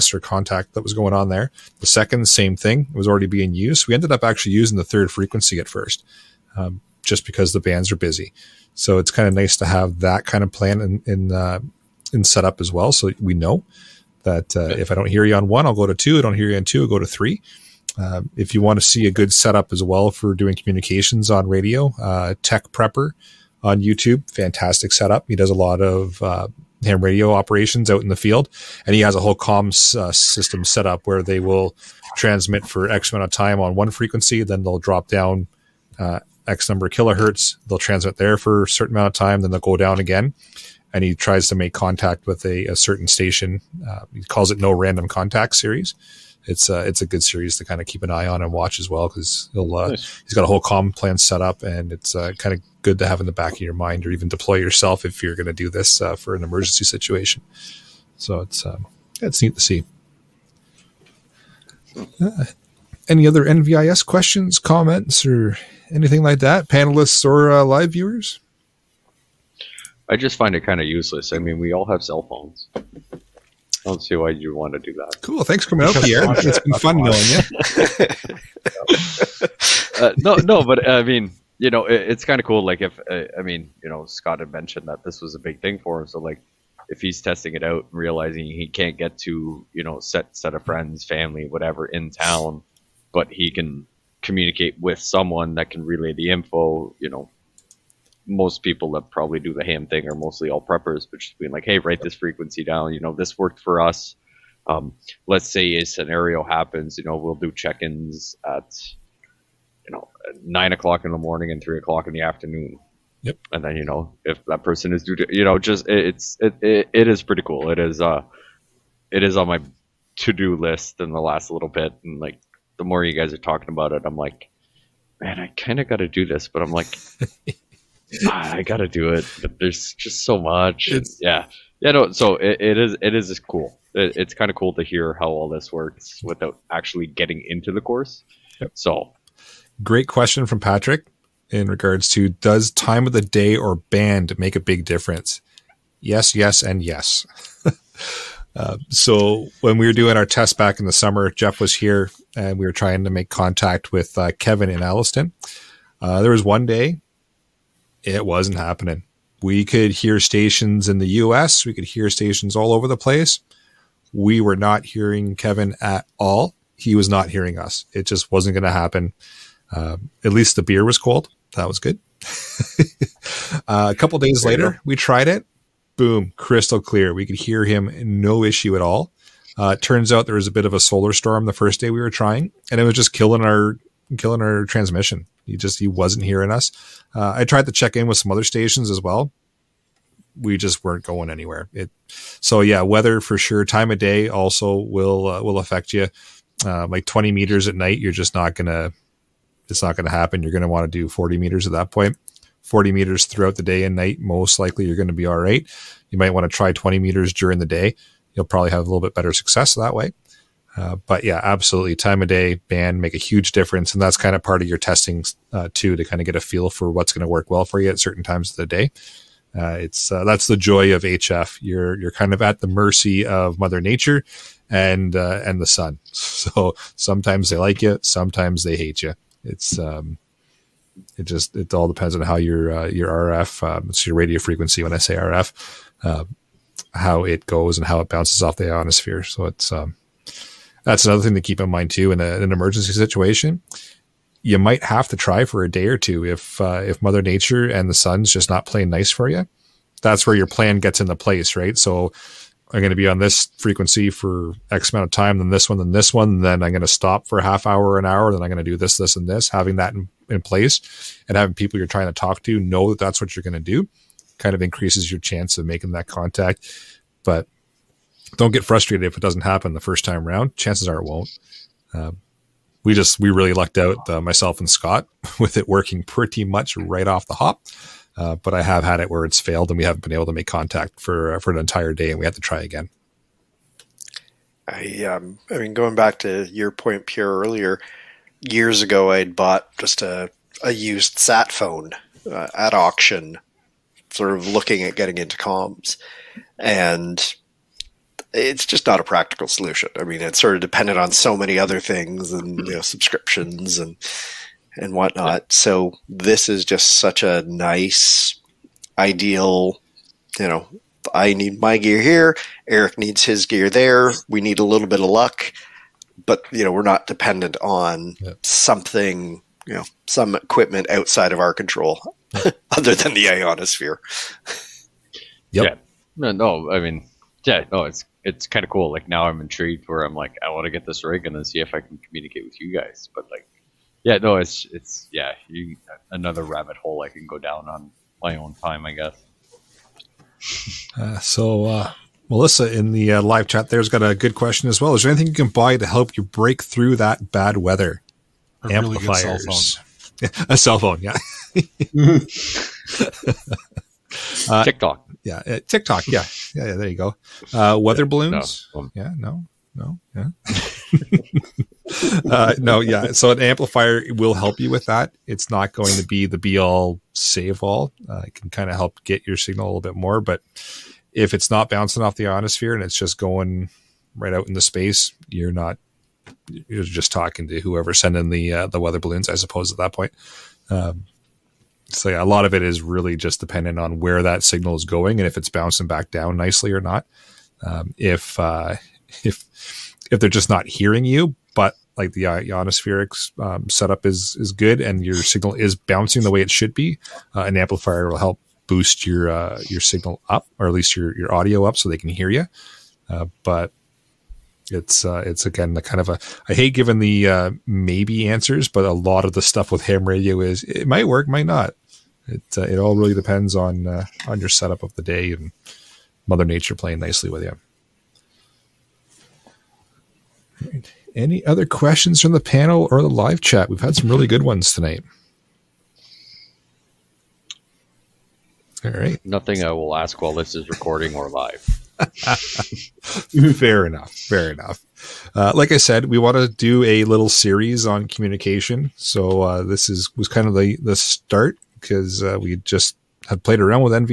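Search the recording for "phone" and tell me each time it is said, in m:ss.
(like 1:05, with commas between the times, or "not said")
1:12, 4:51, 5:50.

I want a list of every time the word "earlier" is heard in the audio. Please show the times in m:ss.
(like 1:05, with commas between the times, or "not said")
4:47.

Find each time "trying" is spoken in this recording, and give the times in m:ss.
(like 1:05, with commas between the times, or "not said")
2:32, 3:02, 4:21.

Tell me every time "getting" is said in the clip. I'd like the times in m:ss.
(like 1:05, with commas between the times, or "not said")
2:17, 4:54.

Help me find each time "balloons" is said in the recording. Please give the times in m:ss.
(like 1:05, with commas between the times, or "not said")
5:58, 6:18.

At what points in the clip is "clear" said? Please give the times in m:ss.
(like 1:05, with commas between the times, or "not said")
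2:56.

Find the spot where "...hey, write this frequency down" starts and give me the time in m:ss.
1:41.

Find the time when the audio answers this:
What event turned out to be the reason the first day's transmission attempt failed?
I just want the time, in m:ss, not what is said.
3:00.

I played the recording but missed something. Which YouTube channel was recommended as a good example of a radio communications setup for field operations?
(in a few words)
Tech Prepper.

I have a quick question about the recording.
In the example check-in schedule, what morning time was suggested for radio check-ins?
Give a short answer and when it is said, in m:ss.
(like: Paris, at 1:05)
9:00 in the morning, at 1:50.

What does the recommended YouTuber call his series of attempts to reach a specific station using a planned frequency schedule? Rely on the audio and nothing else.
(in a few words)
no random contact series.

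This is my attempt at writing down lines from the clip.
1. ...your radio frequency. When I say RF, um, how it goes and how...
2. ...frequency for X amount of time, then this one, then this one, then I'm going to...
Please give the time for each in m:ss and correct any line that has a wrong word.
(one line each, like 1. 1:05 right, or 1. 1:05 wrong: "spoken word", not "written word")
1. 3:54 right
2. 4:13 right.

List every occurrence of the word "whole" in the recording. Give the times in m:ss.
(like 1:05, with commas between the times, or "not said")
0:29, 0:50.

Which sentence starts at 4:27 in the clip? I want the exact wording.
But don't get frustrated if it doesn't happen the first time around.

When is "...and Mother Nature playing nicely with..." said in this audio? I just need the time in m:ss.
6:55.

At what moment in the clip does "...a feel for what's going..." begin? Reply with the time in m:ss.
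3:36.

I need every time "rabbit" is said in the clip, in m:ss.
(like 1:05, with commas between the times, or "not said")
5:36.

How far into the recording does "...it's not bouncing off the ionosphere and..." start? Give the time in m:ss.
6:11.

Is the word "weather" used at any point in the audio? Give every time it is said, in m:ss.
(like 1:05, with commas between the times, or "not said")
3:12, 5:47, 5:57, 6:18.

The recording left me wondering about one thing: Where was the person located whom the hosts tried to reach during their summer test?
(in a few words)
Alliston.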